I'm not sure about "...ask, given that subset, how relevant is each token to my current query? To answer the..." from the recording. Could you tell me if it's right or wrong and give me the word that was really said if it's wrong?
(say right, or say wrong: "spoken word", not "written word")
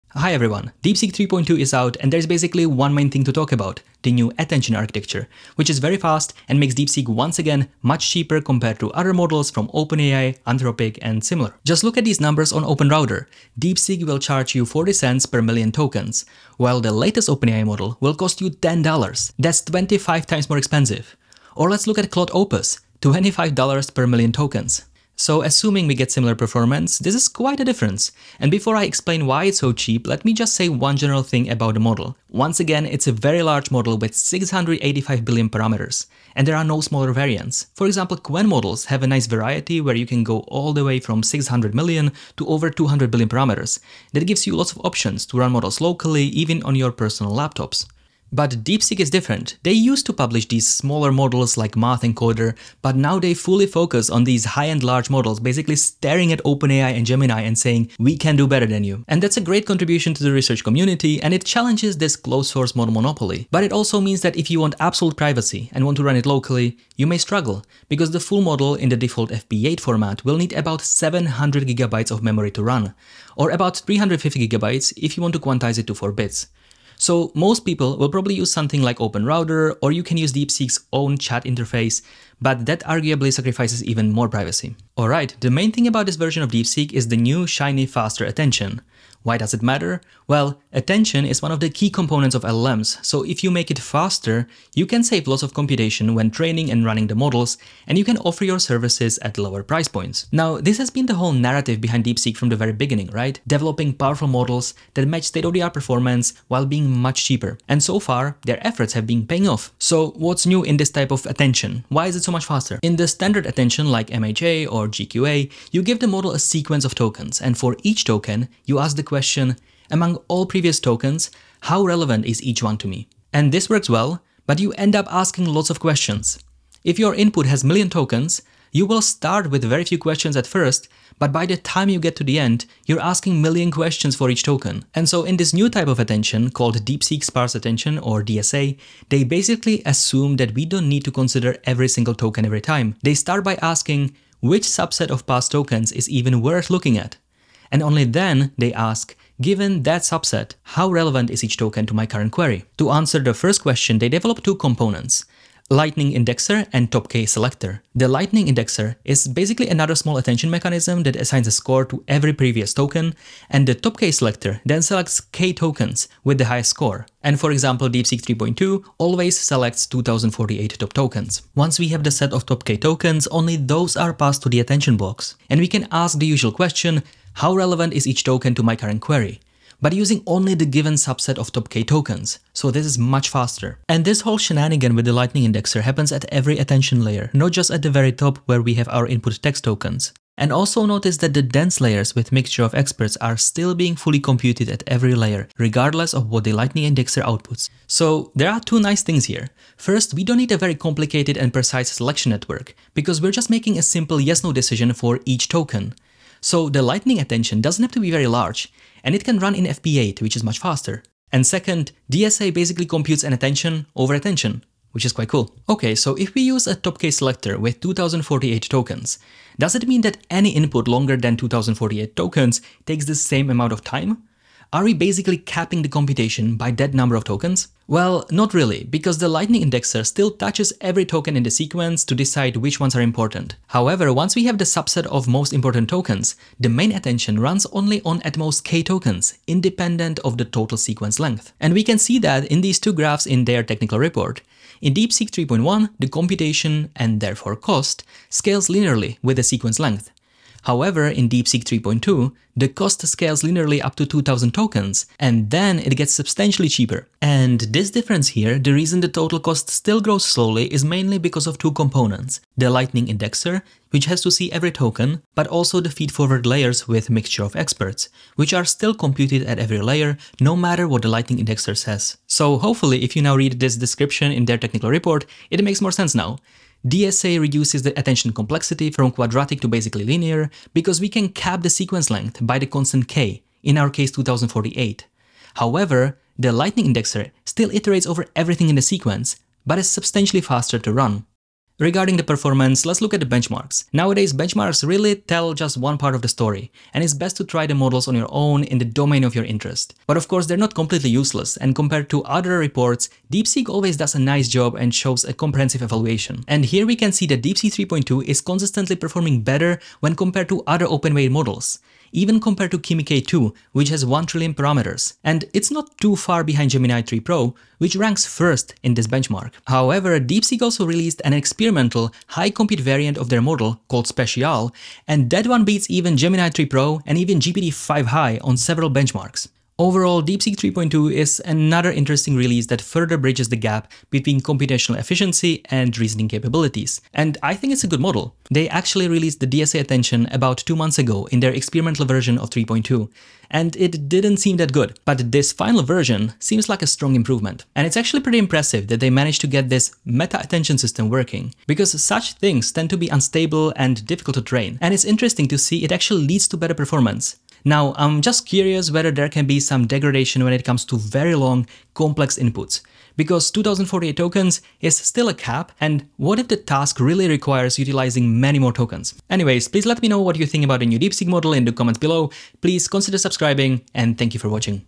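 right.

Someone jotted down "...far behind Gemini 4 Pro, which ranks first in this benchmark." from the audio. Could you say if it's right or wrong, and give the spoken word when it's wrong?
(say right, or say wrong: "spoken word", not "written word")
wrong: "3", not "4".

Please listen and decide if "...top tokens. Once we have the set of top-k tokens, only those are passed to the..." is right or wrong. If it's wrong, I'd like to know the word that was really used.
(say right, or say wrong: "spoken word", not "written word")
right.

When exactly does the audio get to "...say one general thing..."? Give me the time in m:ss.
0:30.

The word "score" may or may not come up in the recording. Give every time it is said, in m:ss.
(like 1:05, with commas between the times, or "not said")
2:41, 2:46.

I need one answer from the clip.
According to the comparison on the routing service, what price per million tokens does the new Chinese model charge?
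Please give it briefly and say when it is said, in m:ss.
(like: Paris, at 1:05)
40 cents, at 0:14.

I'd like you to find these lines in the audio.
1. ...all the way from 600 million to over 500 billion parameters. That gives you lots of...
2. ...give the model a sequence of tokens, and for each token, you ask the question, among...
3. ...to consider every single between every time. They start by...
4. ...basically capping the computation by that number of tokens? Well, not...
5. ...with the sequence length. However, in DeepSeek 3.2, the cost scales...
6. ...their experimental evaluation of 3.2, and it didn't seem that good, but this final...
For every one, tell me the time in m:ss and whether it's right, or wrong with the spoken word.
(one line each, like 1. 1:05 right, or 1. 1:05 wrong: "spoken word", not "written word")
1. 0:40 wrong: "200", not "500"
2. 1:55 right
3. 2:21 wrong: "token", not "between"
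4. 3:44 right
5. 4:09 right
6. 5:41 wrong: "version", not "evaluation".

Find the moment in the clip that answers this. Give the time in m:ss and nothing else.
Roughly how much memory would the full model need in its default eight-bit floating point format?
1:10.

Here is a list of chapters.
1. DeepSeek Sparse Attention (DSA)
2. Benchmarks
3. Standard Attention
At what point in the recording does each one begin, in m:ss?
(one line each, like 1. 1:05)
1. 2:15
2. 4:51
3. 1:52.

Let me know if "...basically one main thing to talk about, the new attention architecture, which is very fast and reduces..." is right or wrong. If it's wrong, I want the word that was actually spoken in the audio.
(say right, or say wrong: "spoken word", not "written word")
wrong: "makes", not "reduces".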